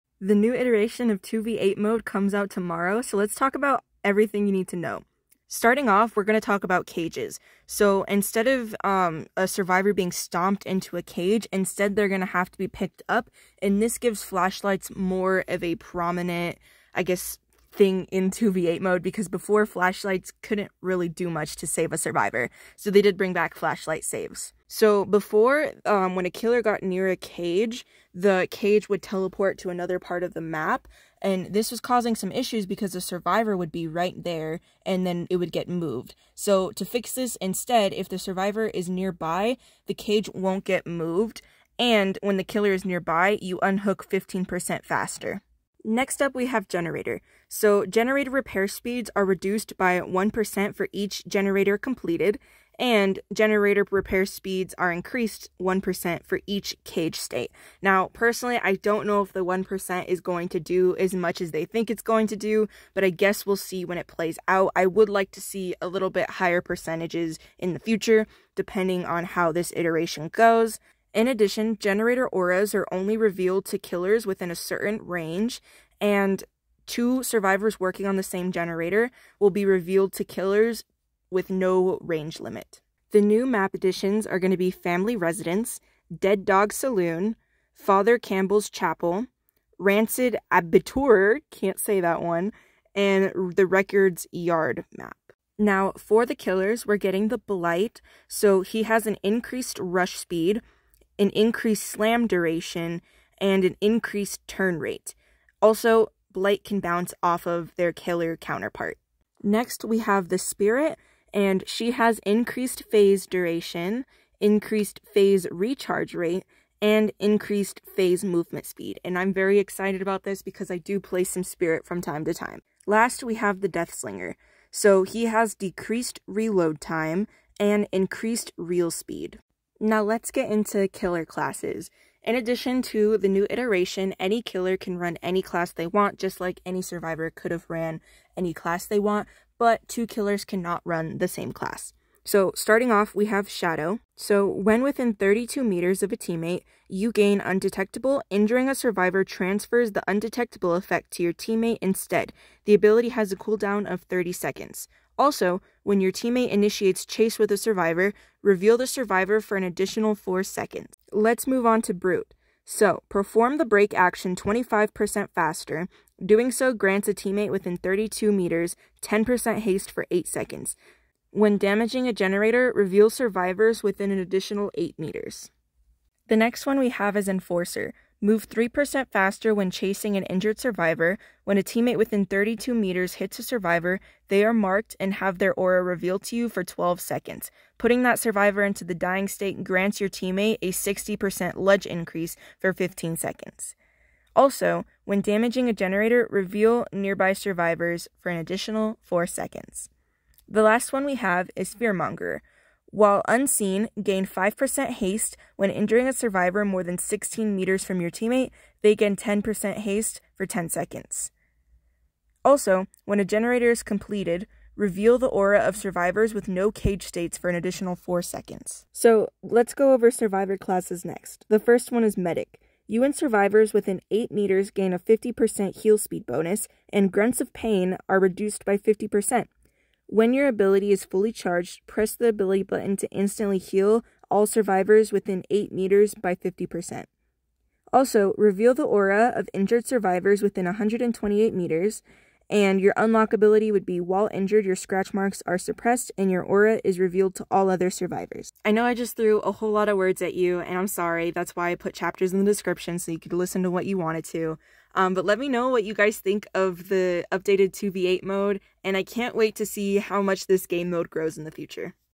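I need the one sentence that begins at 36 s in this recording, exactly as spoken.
So to fix this instead, if the survivor is nearby, the cage won't get moved.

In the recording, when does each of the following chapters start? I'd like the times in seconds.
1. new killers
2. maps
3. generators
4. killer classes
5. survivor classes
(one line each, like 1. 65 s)
1. 95 s
2. 82 s
3. 45 s
4. 130 s
5. 218 s.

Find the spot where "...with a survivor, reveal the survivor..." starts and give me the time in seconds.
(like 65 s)
157 s.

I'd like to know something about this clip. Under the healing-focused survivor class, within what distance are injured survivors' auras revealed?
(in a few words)
128 meters.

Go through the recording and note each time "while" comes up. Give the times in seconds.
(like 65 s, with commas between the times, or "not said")
202 s, 244 s.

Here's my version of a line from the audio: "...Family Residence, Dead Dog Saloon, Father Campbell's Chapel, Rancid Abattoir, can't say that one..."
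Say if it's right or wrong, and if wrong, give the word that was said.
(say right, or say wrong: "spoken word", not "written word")
right.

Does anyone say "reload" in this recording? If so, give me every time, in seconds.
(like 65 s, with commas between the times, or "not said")
126 s.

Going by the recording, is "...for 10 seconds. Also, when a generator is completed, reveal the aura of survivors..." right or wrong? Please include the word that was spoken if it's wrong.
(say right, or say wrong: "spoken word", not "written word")
right.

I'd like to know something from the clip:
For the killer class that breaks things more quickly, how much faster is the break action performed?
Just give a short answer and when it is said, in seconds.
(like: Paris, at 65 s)
25%, at 164 s.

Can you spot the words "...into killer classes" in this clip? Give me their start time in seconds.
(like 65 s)
130 s.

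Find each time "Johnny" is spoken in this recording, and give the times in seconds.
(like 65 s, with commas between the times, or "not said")
not said.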